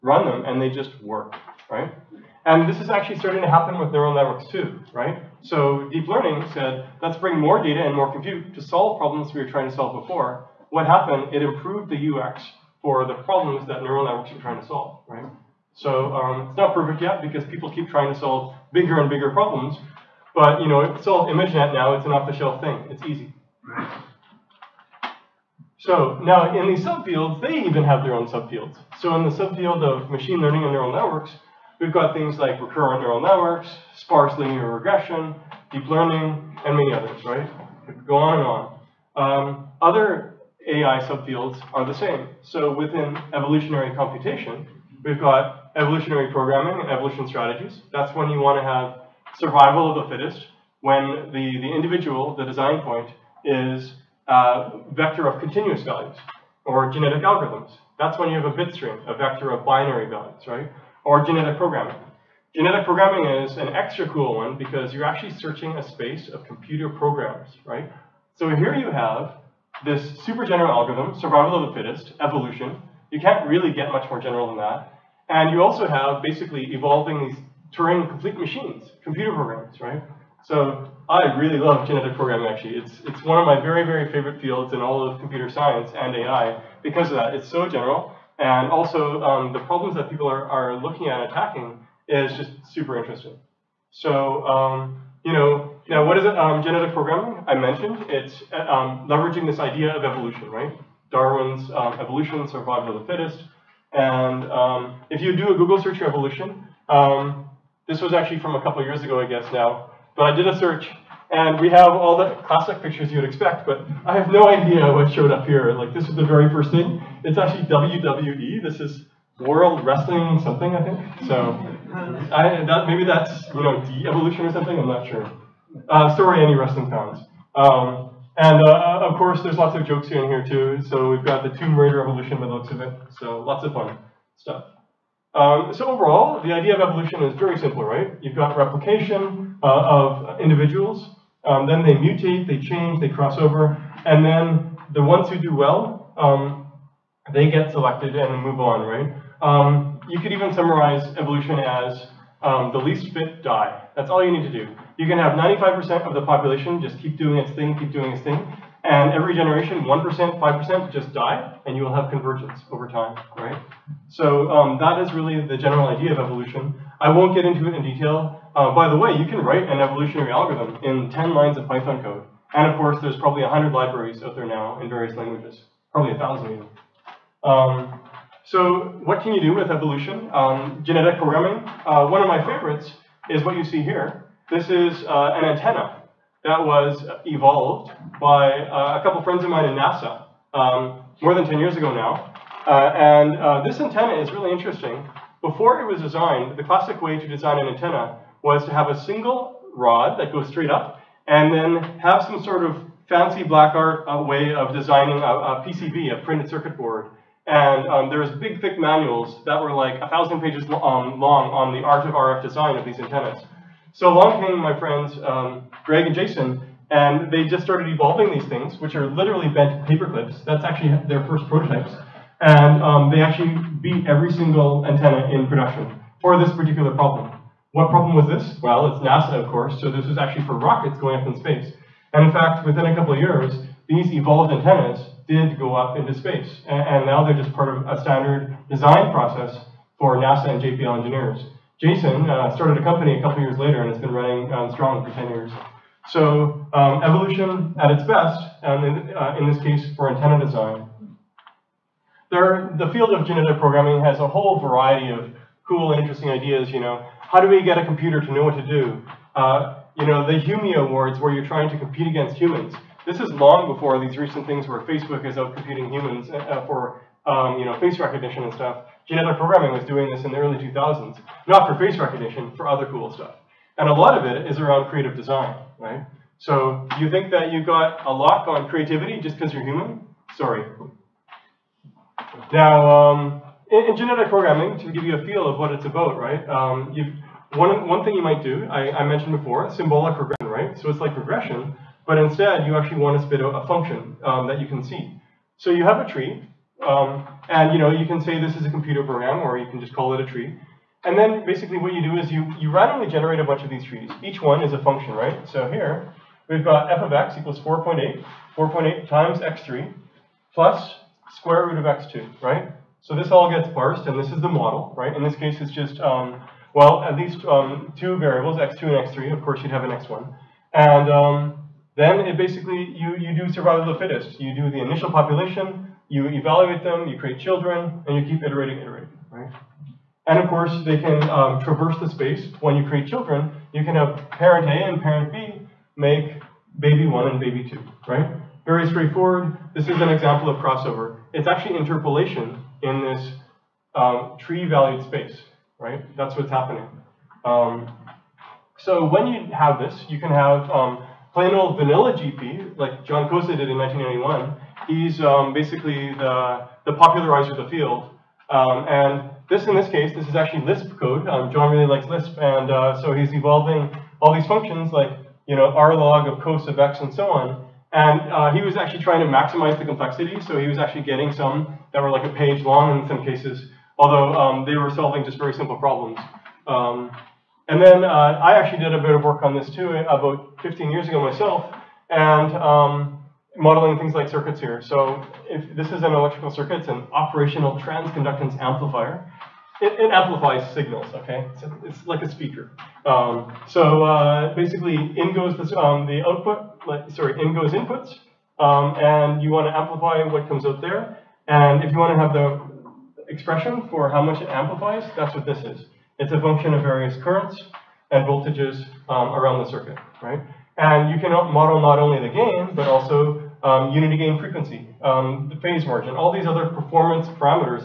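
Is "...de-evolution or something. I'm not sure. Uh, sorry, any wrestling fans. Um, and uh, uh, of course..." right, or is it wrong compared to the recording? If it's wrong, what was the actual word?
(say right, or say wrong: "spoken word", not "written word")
right.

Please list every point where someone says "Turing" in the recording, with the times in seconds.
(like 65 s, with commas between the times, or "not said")
77 s.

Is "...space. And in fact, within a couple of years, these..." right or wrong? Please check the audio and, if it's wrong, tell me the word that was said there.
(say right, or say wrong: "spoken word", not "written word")
right.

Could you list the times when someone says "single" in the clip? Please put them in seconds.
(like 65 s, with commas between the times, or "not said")
199 s, 224 s.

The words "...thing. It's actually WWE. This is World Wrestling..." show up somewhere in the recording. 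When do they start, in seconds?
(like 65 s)
116 s.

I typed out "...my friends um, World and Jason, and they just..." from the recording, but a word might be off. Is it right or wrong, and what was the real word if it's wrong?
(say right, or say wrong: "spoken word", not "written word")
wrong: "Greg", not "World".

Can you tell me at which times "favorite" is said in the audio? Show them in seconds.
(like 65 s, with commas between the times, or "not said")
84 s, 182 s.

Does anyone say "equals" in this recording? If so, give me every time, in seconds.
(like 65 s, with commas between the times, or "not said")
307 s.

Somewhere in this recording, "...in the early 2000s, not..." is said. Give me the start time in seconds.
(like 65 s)
270 s.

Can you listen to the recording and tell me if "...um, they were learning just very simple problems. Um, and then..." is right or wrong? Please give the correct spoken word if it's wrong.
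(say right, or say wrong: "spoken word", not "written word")
wrong: "solving", not "learning".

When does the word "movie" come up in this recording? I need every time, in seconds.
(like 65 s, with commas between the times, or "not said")
not said.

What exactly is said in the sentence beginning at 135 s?
Um, so overall, the idea of evolution is very simple, right?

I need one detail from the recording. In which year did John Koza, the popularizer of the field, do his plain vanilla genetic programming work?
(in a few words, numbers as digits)
1991.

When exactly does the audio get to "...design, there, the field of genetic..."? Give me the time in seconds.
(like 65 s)
250 s.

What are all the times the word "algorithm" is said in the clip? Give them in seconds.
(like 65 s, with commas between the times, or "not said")
57 s, 70 s, 170 s.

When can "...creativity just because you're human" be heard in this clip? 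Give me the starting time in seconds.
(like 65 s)
278 s.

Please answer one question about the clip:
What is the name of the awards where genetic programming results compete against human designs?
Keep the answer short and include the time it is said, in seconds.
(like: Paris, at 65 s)
Humies Awards, at 260 s.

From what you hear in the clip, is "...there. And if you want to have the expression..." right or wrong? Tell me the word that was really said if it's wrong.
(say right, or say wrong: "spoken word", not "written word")
right.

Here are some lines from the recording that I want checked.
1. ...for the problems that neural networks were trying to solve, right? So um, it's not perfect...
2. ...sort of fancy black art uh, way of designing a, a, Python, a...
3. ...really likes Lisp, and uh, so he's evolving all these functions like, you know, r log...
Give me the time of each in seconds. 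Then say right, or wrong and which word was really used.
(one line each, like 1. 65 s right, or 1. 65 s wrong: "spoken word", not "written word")
1. 12 s right
2. 202 s wrong: "PCB", not "Python"
3. 361 s right.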